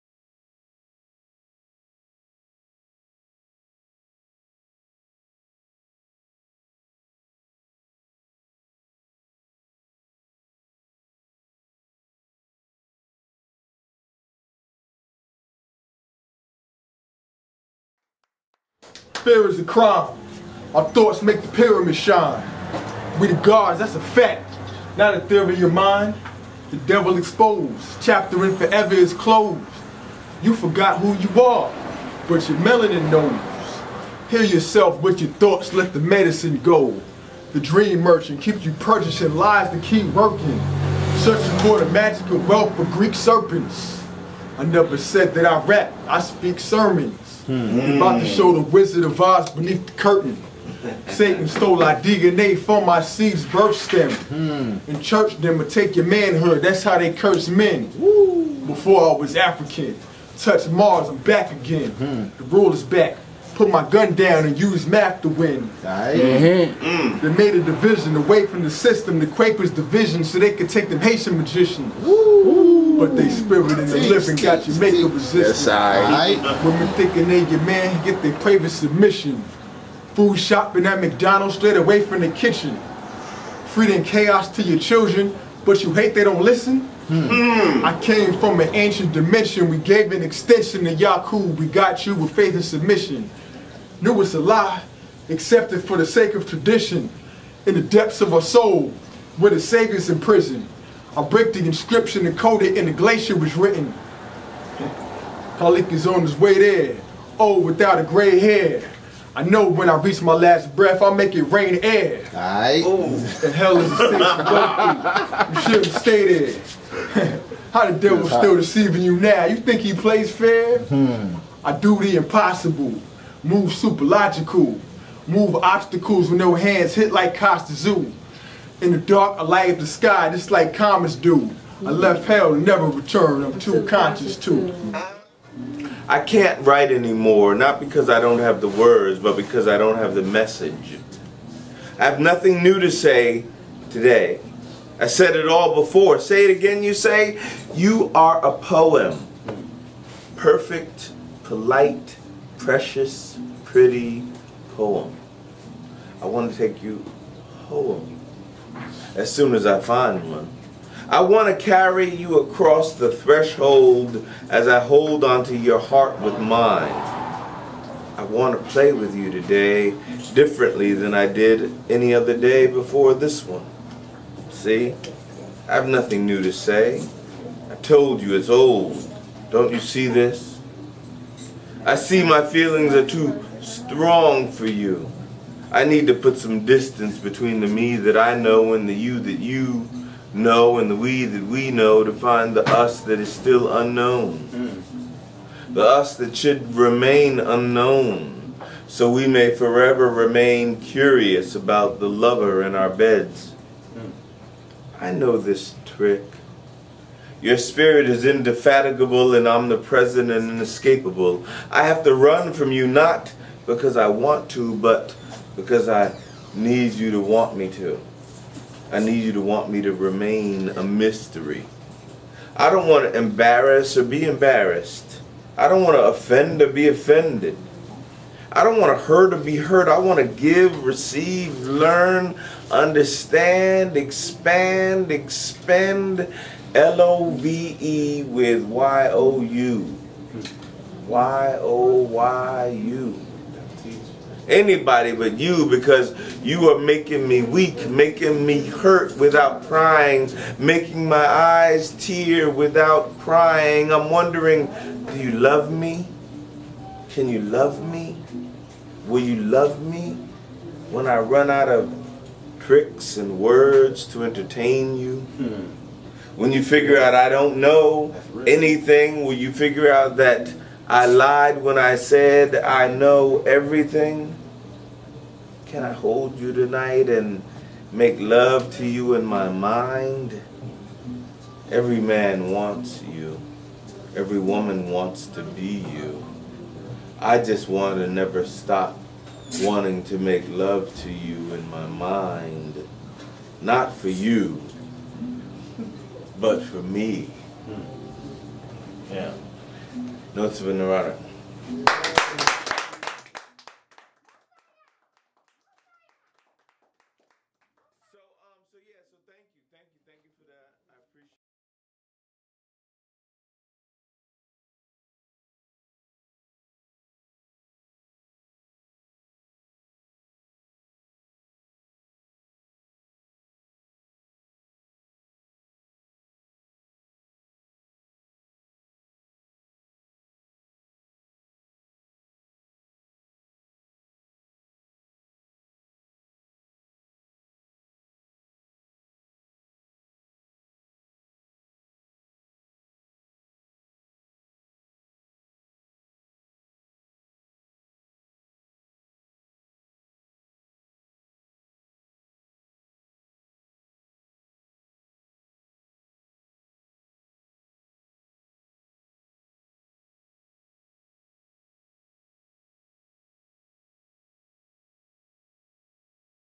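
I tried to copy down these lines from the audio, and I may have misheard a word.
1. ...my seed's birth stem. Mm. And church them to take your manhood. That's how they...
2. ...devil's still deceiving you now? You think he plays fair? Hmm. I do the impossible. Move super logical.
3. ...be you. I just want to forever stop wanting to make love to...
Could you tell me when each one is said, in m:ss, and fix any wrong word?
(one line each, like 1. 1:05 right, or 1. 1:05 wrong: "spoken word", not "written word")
1. 0:52 right
2. 1:57 right
3. 4:45 wrong: "never", not "forever".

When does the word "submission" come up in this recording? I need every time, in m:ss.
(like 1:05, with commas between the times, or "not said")
1:18, 1:32.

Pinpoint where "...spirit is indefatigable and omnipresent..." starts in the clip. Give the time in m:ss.
3:27.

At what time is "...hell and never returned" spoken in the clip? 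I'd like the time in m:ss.
2:12.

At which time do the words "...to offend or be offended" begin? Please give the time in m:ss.
3:45.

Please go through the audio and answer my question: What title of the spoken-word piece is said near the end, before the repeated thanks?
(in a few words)
Notes of a neurotic.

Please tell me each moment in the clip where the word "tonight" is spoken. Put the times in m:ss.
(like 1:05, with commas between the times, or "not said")
4:36.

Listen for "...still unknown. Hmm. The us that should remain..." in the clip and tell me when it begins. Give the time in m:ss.
3:13.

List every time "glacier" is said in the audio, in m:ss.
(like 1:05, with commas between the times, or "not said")
1:42.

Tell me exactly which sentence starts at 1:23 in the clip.
Feeding chaos to your children, but you hate they don't listen?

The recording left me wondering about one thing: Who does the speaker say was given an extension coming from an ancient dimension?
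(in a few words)
Yakub.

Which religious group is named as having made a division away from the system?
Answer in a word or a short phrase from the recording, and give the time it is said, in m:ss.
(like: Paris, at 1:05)
Quakers, at 1:09.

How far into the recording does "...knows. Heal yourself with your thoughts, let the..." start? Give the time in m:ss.
0:33.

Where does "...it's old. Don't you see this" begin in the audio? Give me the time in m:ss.
2:58.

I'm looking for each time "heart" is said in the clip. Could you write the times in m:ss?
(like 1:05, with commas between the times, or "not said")
2:45.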